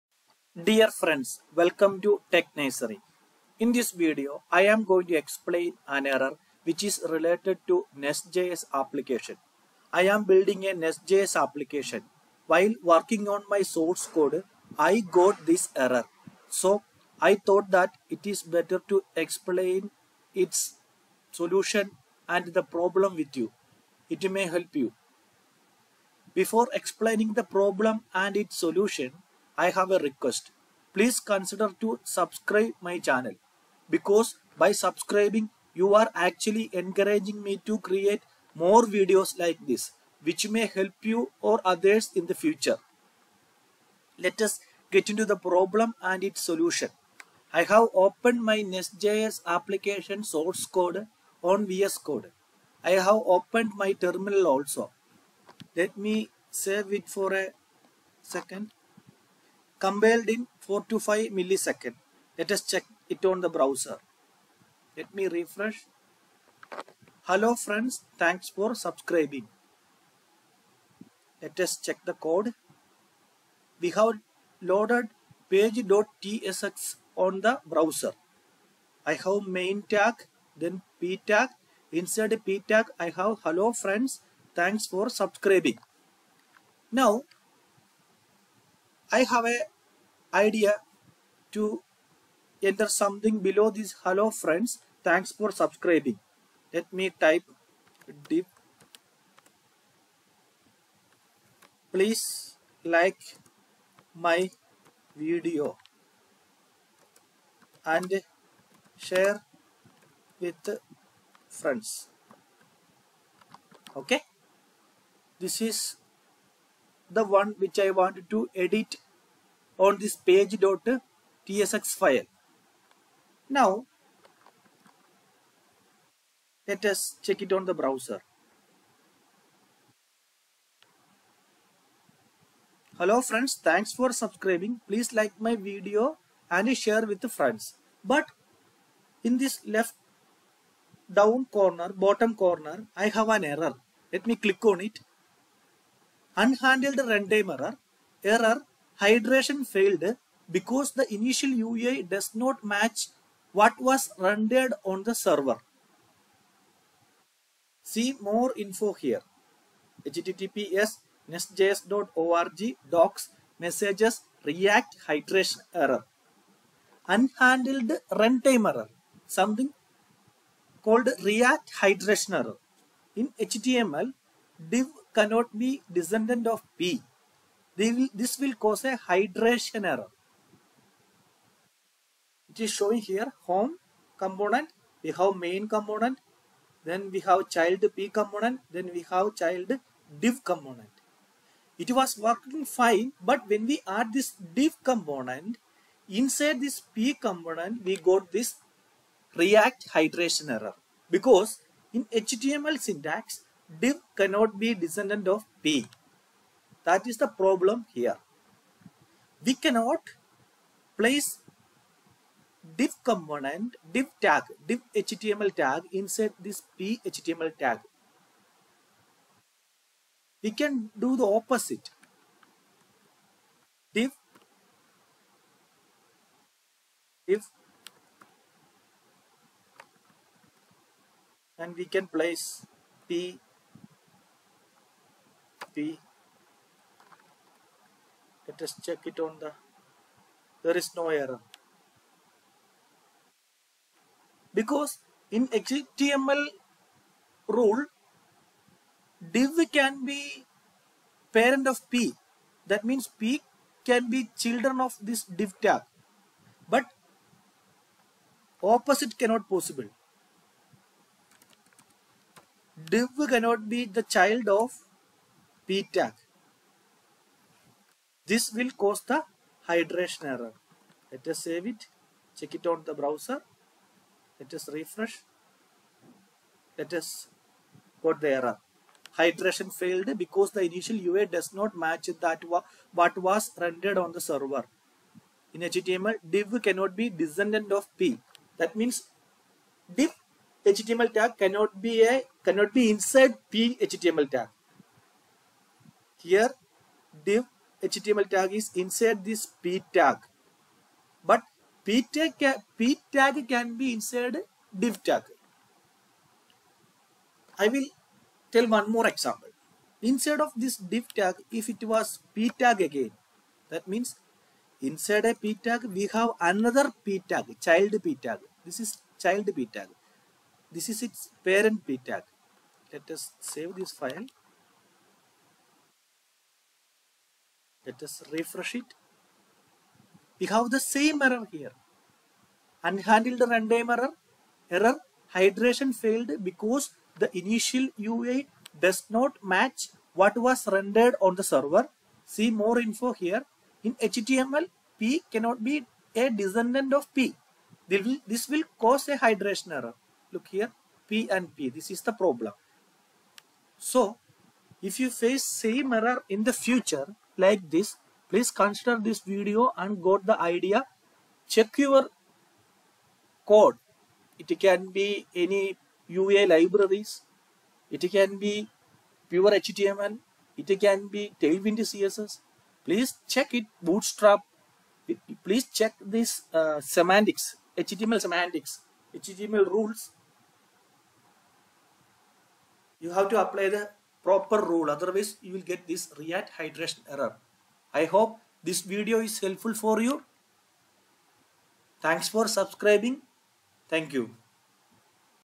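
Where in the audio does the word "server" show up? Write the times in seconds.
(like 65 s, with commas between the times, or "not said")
155 s, 284 s, 341 s.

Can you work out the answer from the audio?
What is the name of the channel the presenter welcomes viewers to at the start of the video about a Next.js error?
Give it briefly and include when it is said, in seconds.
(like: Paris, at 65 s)
Tech Nursery, at 2 s.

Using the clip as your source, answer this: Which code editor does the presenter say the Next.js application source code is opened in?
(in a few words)
VS Code.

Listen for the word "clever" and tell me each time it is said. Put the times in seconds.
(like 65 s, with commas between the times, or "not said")
not said.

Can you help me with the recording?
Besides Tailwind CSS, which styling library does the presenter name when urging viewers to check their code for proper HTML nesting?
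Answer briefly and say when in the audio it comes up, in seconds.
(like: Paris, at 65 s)
Bootstrap, at 373 s.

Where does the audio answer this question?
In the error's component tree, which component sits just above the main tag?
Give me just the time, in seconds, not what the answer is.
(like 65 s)
183 s.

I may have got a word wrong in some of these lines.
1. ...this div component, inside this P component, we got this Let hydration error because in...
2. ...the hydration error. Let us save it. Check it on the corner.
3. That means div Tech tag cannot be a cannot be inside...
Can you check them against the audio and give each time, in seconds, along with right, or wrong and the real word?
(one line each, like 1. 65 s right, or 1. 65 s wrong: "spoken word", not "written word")
1. 194 s wrong: "React", not "Let"
2. 269 s wrong: "browser", not "corner"
3. 288 s wrong: "HTML", not "Tech".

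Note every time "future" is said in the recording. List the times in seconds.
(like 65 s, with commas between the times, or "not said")
42 s, 356 s.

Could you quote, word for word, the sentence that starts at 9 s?
I am building a Next.js application.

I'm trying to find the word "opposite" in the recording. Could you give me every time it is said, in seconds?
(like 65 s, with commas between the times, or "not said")
221 s, 258 s.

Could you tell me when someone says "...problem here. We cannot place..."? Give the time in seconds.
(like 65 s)
207 s.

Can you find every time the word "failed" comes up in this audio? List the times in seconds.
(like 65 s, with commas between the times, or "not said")
149 s, 279 s, 335 s.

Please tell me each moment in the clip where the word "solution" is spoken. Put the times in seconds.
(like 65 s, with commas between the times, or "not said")
21 s, 28 s, 46 s.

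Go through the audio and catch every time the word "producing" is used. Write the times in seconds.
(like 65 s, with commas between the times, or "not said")
not said.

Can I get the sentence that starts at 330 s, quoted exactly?
We have the same error here.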